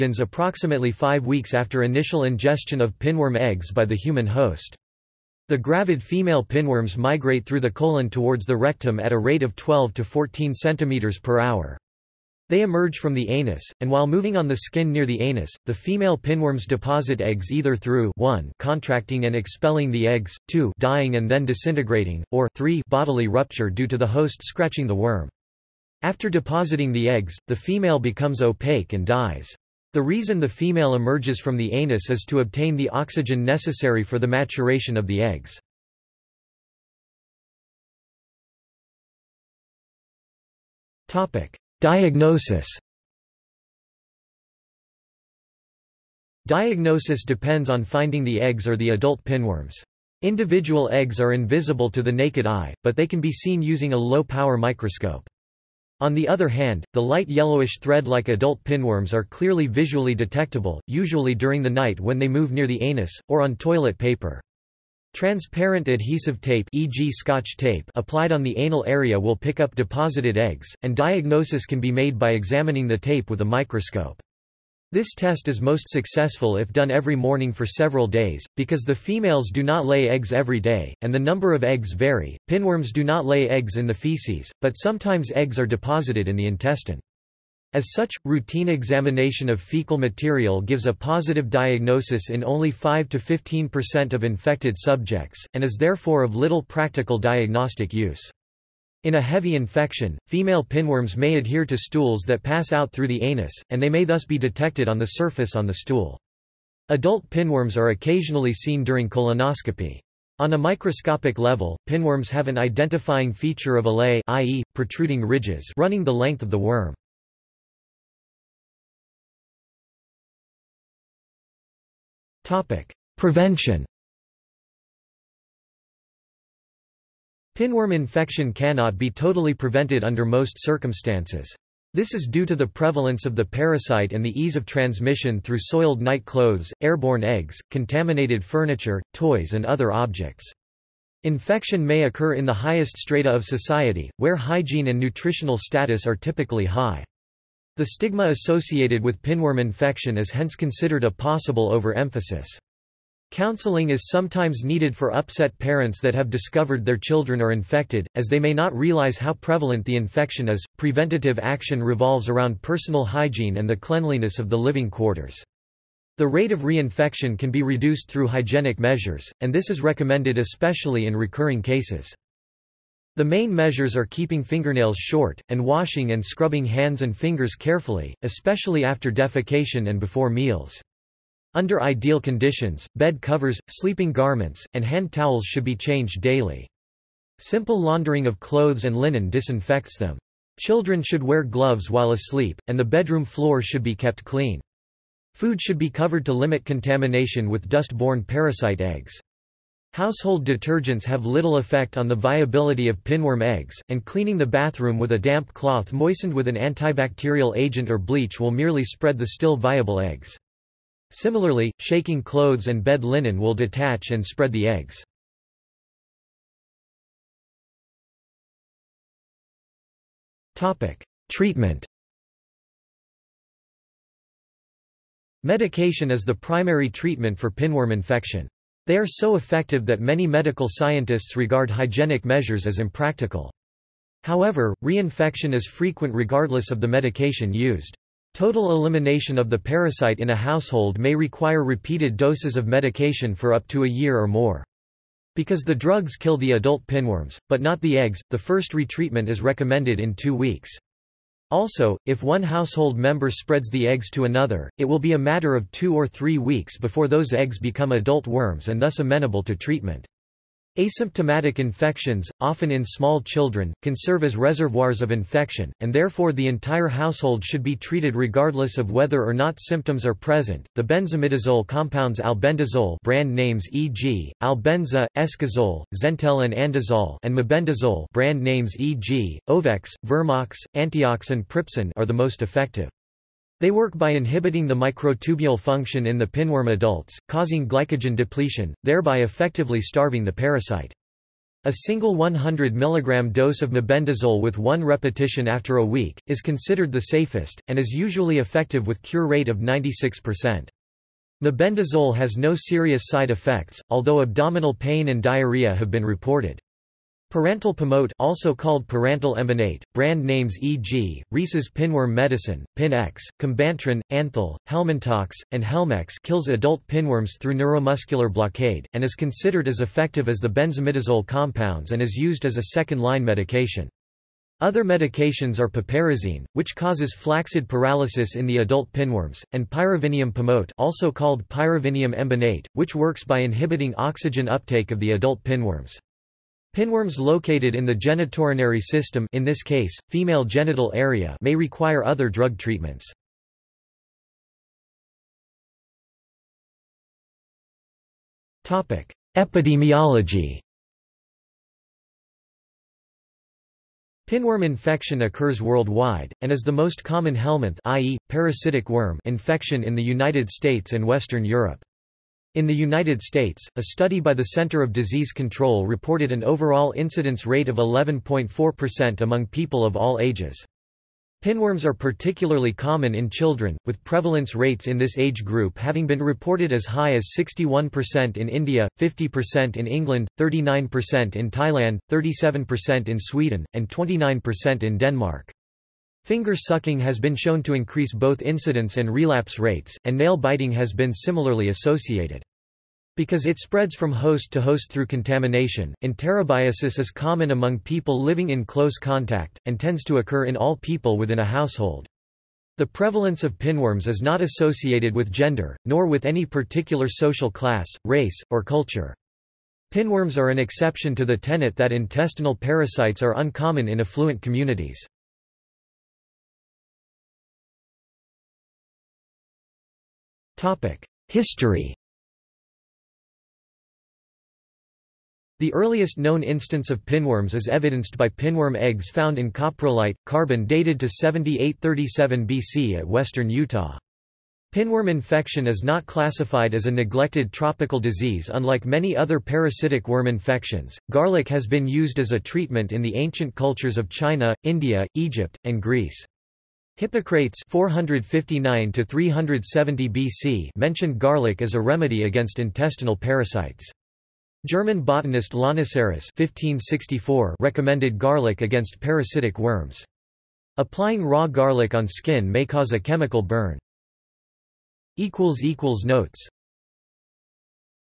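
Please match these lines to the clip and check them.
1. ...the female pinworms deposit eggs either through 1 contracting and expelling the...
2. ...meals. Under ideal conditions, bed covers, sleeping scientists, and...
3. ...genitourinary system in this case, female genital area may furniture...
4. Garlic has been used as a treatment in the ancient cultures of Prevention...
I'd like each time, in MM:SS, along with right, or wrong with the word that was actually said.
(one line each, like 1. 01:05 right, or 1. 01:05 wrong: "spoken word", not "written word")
1. 00:15 right
2. 03:00 wrong: "garments", not "scientists"
3. 05:37 wrong: "require", not "furniture"
4. 07:21 wrong: "China", not "Prevention".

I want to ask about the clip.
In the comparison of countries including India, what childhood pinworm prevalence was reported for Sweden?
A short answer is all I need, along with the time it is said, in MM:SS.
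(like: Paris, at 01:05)
37%, at 06:22.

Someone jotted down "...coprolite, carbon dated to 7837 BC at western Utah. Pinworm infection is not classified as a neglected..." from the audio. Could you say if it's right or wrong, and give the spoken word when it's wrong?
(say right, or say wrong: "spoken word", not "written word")
right.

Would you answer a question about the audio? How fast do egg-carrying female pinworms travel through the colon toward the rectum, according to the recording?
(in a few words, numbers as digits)
12 to 14 centimeters per hour.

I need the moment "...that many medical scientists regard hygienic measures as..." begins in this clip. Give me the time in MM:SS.
03:49.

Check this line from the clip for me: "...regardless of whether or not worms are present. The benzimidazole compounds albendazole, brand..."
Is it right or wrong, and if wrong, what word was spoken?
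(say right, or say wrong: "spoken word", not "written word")
wrong: "symptoms", not "worms".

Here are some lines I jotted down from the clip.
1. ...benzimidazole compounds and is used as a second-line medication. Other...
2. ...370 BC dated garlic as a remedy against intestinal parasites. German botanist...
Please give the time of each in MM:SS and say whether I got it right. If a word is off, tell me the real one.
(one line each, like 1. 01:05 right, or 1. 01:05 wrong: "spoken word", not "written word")
1. 05:20 right
2. 07:29 wrong: "mentioned", not "dated".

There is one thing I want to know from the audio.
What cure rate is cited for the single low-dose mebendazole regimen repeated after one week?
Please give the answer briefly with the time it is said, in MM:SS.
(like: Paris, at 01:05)
96%, at 04:59.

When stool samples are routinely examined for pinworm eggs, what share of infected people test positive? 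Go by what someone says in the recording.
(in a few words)
5 to 15%.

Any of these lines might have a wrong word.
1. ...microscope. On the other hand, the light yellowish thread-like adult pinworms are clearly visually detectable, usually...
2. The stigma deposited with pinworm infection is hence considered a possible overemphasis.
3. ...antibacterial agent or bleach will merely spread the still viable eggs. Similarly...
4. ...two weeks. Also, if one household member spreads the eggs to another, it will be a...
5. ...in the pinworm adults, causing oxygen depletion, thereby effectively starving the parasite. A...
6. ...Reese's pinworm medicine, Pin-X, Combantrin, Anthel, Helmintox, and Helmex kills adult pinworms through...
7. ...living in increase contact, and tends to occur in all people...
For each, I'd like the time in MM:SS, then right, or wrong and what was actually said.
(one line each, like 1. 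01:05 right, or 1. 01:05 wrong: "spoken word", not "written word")
1. 00:54 right
2. 02:27 wrong: "associated", not "deposited"
3. 03:26 right
4. 04:10 right
5. 04:46 wrong: "glycogen", not "oxygen"
6. 05:11 right
7. 06:38 wrong: "close", not "increase".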